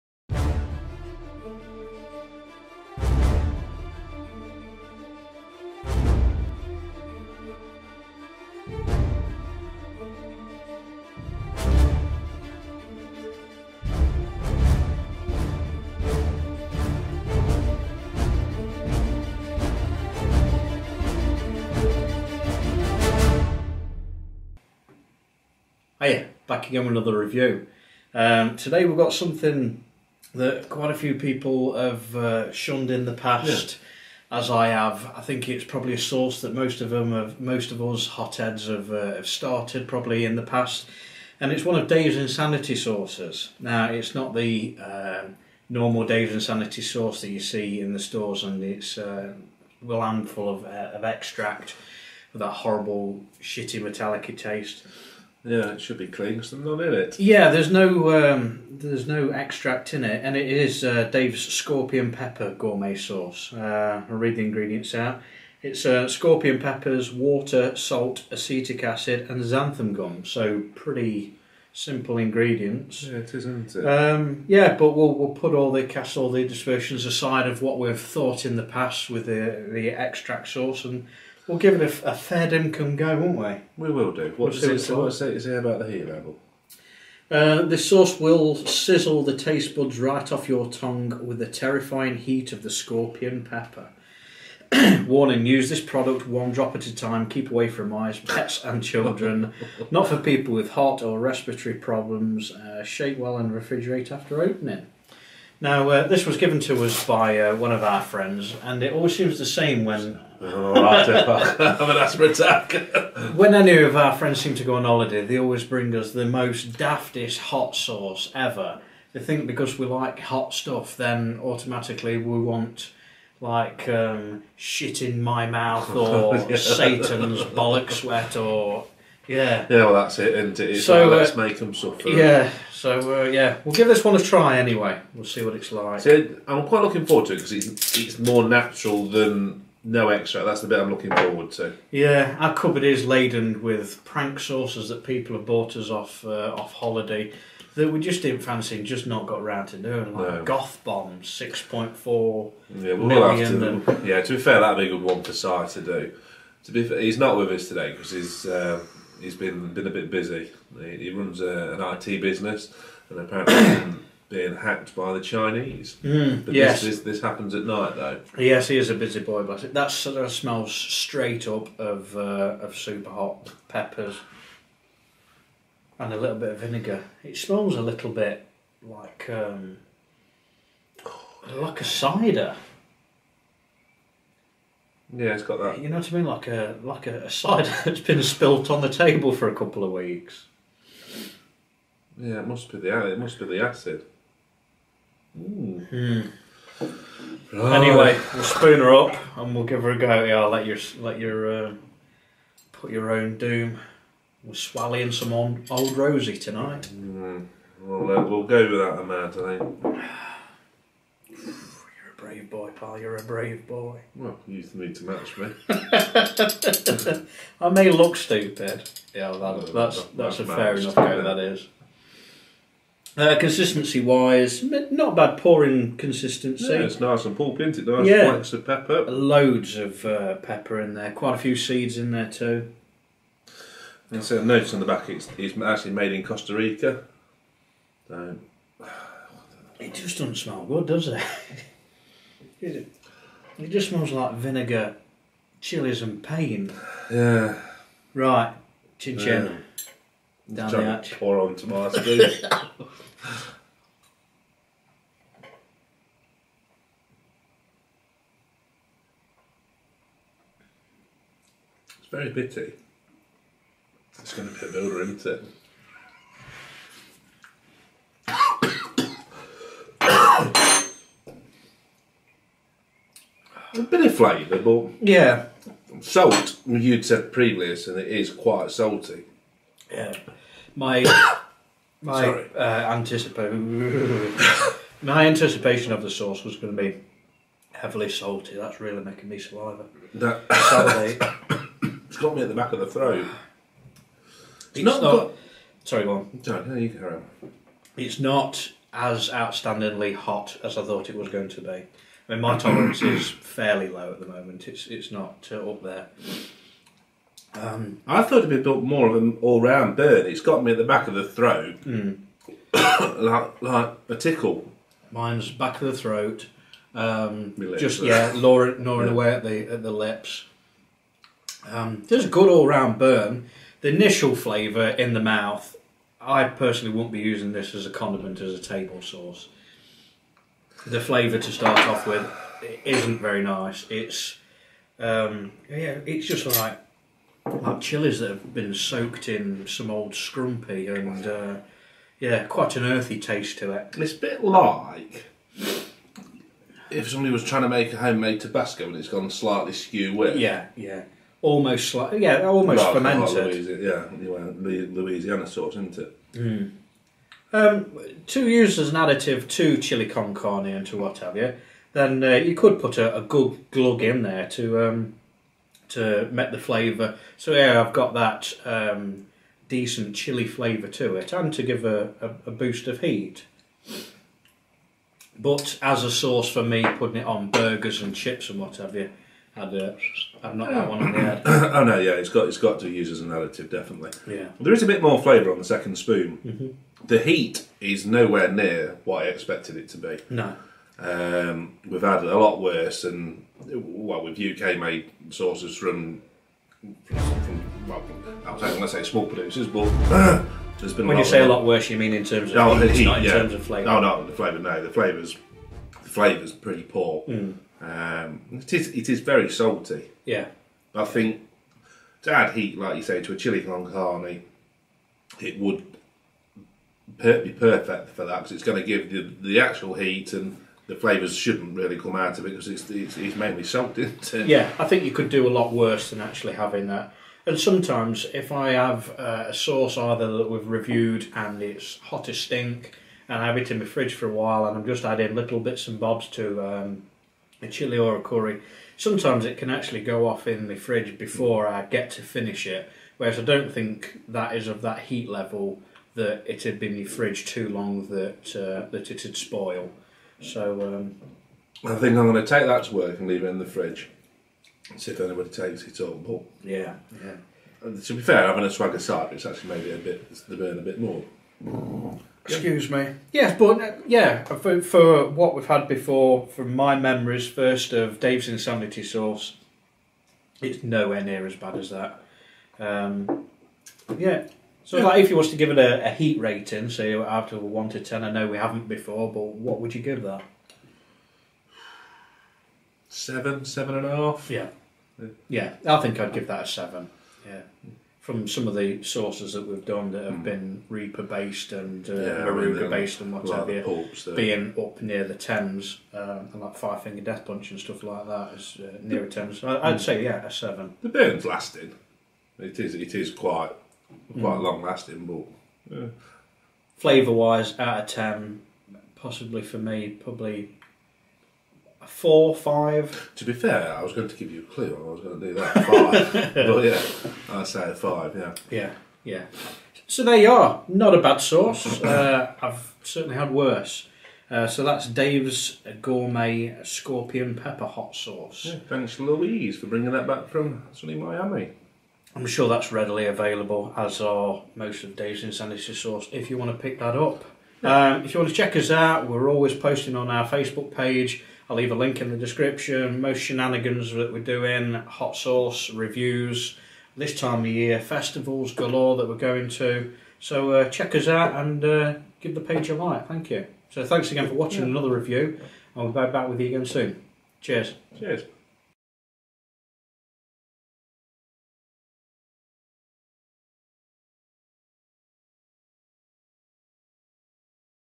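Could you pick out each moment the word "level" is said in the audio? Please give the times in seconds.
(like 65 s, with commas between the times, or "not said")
86 s, 445 s.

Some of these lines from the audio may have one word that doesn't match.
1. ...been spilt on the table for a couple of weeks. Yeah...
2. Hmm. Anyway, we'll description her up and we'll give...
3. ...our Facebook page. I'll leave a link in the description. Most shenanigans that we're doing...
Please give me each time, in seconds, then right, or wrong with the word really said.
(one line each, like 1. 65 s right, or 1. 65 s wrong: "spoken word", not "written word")
1. 187 s right
2. 195 s wrong: "spoon", not "description"
3. 540 s right.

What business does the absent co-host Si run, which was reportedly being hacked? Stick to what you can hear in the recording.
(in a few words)
IT business.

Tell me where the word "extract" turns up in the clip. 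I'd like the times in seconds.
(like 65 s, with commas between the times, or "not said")
51 s, 59 s, 79 s, 140 s.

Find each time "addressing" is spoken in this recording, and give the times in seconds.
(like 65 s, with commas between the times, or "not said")
not said.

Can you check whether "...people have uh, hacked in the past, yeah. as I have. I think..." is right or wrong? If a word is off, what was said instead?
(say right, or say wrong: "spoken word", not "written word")
wrong: "shunned", not "hacked".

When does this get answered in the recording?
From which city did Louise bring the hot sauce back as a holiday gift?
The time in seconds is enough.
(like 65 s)
531 s.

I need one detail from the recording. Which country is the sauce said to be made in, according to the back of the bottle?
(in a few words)
Costa Rica.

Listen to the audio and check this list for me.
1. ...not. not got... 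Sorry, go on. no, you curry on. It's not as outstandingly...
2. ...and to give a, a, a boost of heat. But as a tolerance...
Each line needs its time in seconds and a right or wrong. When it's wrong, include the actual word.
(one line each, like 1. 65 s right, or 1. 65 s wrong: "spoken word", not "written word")
1. 294 s wrong: "carry", not "curry"
2. 371 s wrong: "sauce", not "tolerance".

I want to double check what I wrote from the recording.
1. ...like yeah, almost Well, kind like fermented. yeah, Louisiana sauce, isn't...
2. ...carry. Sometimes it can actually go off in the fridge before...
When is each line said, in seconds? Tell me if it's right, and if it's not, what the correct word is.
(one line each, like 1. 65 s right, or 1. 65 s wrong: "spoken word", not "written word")
1. 351 s right
2. 438 s wrong: "curry", not "carry".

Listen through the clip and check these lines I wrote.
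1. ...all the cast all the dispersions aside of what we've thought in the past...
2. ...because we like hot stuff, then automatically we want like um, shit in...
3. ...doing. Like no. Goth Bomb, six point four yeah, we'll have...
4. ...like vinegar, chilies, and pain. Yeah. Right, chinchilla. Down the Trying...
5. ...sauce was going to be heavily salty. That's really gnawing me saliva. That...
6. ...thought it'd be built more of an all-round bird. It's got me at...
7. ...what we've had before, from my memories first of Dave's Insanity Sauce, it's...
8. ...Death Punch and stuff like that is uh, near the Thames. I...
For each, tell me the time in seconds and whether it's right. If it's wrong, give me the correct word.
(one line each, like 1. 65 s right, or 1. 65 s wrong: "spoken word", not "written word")
1. 75 s right
2. 119 s right
3. 149 s right
4. 244 s right
5. 286 s wrong: "making", not "gnawing"
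6. 308 s right
7. 465 s right
8. 497 s right.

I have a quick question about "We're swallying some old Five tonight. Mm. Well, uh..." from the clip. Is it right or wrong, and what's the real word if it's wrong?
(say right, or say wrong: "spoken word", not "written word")
wrong: "Rosie", not "Five".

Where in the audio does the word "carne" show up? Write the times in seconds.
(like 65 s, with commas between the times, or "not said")
360 s, 413 s.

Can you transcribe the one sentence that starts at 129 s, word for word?
Yeah, well, that's it, and it's so, like, uh, let's make them suffer.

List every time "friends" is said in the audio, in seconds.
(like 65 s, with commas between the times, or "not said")
108 s, 114 s.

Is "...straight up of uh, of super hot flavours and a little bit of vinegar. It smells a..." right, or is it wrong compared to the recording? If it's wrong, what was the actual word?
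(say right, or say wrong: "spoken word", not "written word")
wrong: "peppers", not "flavours".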